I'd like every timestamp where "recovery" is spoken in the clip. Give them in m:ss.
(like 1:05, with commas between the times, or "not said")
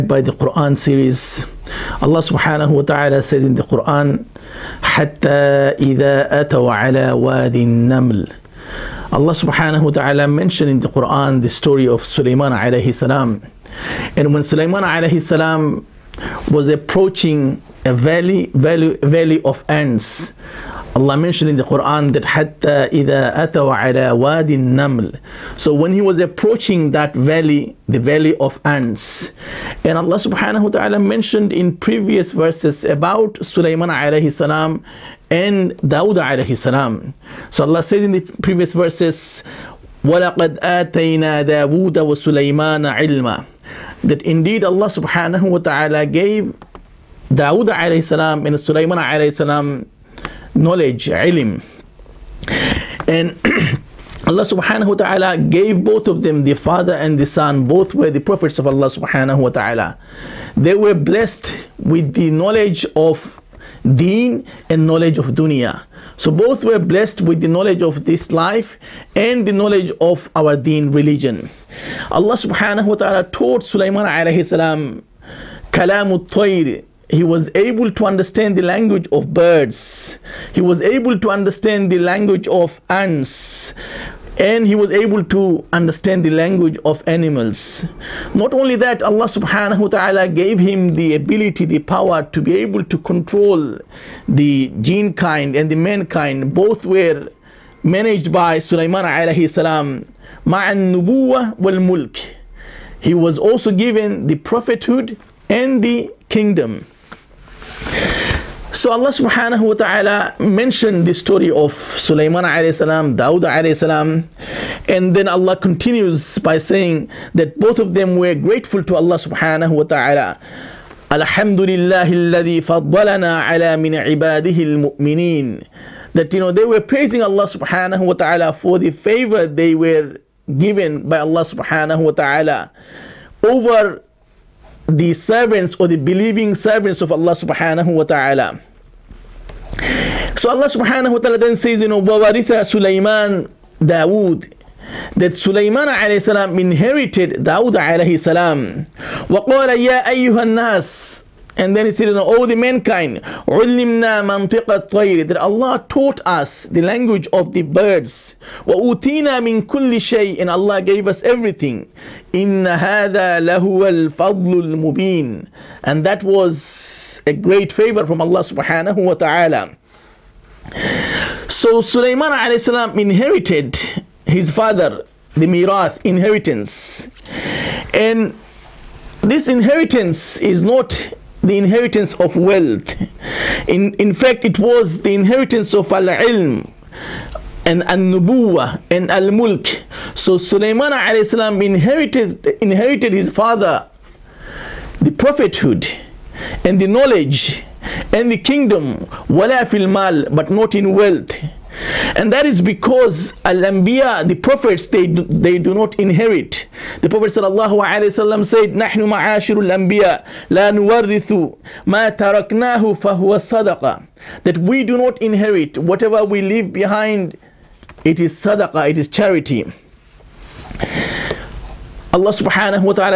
not said.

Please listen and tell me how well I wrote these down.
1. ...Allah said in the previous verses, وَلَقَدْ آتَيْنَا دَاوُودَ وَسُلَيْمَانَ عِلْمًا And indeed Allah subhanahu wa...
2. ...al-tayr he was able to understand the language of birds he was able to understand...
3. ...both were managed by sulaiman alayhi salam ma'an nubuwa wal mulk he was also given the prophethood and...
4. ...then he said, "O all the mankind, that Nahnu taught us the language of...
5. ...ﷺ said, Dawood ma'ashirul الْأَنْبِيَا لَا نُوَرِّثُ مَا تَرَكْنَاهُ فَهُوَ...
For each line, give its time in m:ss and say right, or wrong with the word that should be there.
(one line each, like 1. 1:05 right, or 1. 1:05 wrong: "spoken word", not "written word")
1. 0:37 wrong: "That", not "And"
2. 1:16 right
3. 1:36 right
4. 2:31 wrong: "Allah", not "Nahnu"
5. 3:27 wrong: "Nahnu", not "Dawood".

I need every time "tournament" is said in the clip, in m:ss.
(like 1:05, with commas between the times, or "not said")
not said.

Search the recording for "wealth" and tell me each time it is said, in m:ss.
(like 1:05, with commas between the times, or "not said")
3:02, 3:20.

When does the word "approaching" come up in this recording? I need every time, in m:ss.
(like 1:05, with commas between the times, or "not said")
0:16, 0:26.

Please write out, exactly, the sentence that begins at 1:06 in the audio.
So both were blessed with the knowledge of this life and the knowledge of our deen religion.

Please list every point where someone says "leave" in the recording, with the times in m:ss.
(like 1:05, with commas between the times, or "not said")
3:36.